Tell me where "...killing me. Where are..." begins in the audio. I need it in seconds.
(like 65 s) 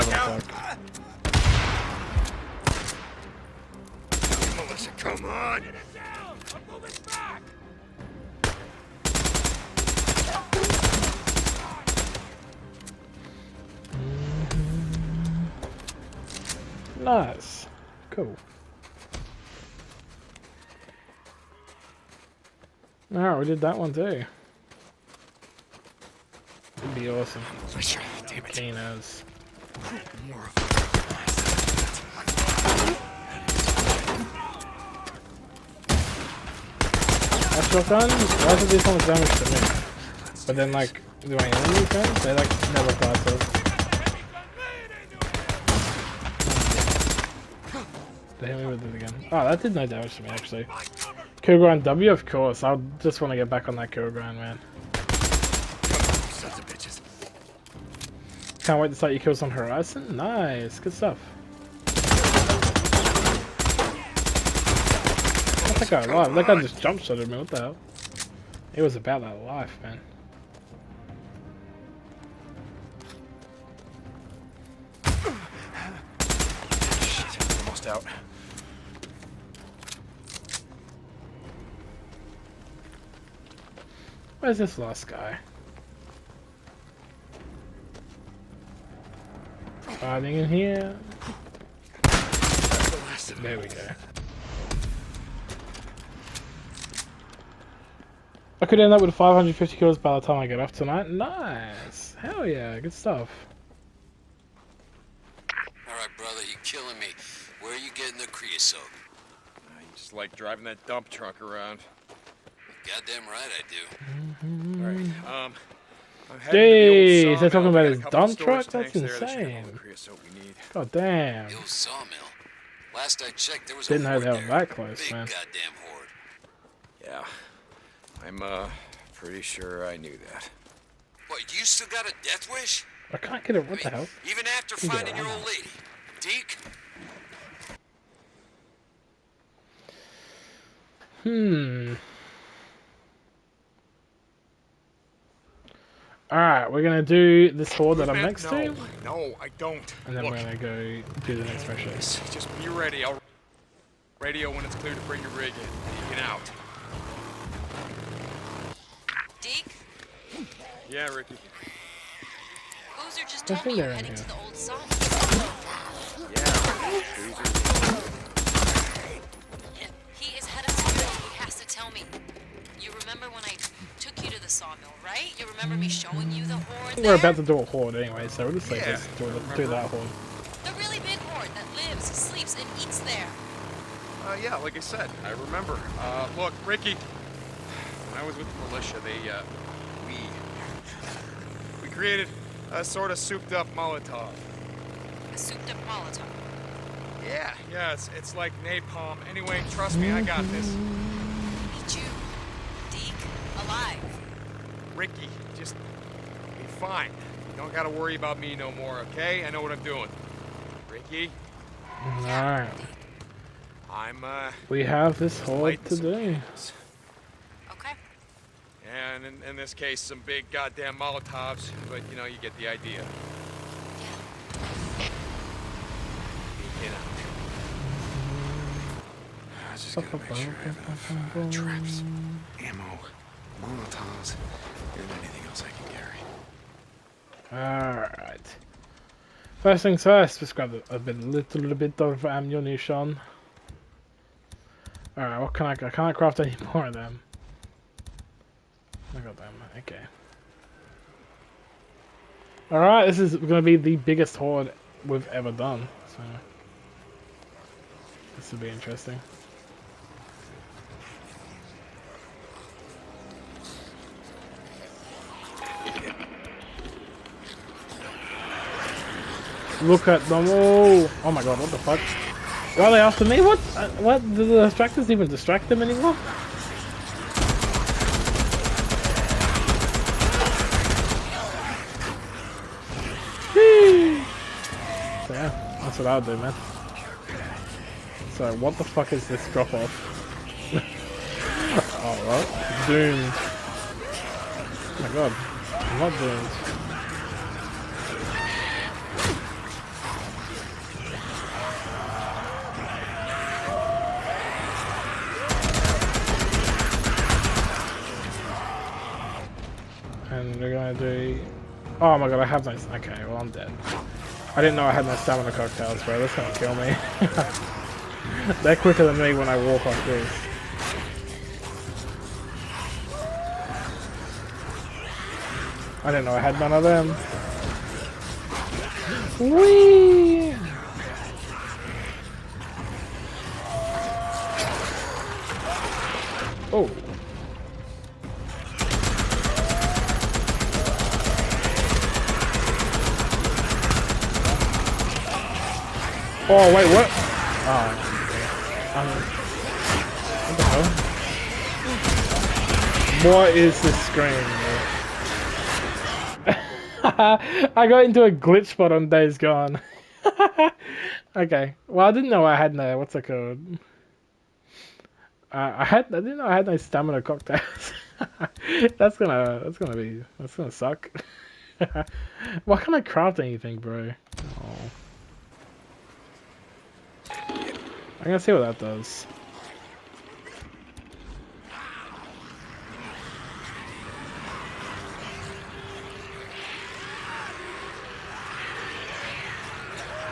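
106 s.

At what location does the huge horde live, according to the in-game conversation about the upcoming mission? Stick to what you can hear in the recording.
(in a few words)
the old sawmill.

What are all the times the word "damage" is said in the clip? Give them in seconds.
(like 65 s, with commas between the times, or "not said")
39 s, 49 s.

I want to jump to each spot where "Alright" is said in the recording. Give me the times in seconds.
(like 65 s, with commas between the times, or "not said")
105 s, 146 s, 212 s, 237 s, 245 s, 252 s.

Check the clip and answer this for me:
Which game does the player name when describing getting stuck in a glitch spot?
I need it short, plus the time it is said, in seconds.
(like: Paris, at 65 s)
Days Gone, at 359 s.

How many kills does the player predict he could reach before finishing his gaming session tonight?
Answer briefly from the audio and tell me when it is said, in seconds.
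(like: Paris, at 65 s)
550, at 99 s.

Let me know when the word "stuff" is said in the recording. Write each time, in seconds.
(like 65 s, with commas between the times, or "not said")
60 s, 102 s.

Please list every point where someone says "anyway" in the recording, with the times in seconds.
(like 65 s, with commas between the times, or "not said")
177 s, 199 s.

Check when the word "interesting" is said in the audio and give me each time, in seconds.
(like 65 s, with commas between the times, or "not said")
258 s.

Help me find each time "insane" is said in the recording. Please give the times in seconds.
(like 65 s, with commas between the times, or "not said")
118 s.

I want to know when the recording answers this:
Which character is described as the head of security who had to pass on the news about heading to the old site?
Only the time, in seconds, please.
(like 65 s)
162 s.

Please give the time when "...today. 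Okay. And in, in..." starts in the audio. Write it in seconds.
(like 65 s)
215 s.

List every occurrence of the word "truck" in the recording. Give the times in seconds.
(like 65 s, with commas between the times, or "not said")
111 s, 118 s.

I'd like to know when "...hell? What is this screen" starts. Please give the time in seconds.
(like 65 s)
351 s.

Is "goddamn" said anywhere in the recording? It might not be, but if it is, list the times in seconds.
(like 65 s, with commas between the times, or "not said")
112 s, 125 s, 220 s.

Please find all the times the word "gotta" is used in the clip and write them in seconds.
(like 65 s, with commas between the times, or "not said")
207 s, 378 s.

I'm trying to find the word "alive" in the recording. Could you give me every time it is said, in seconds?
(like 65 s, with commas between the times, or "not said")
66 s, 203 s.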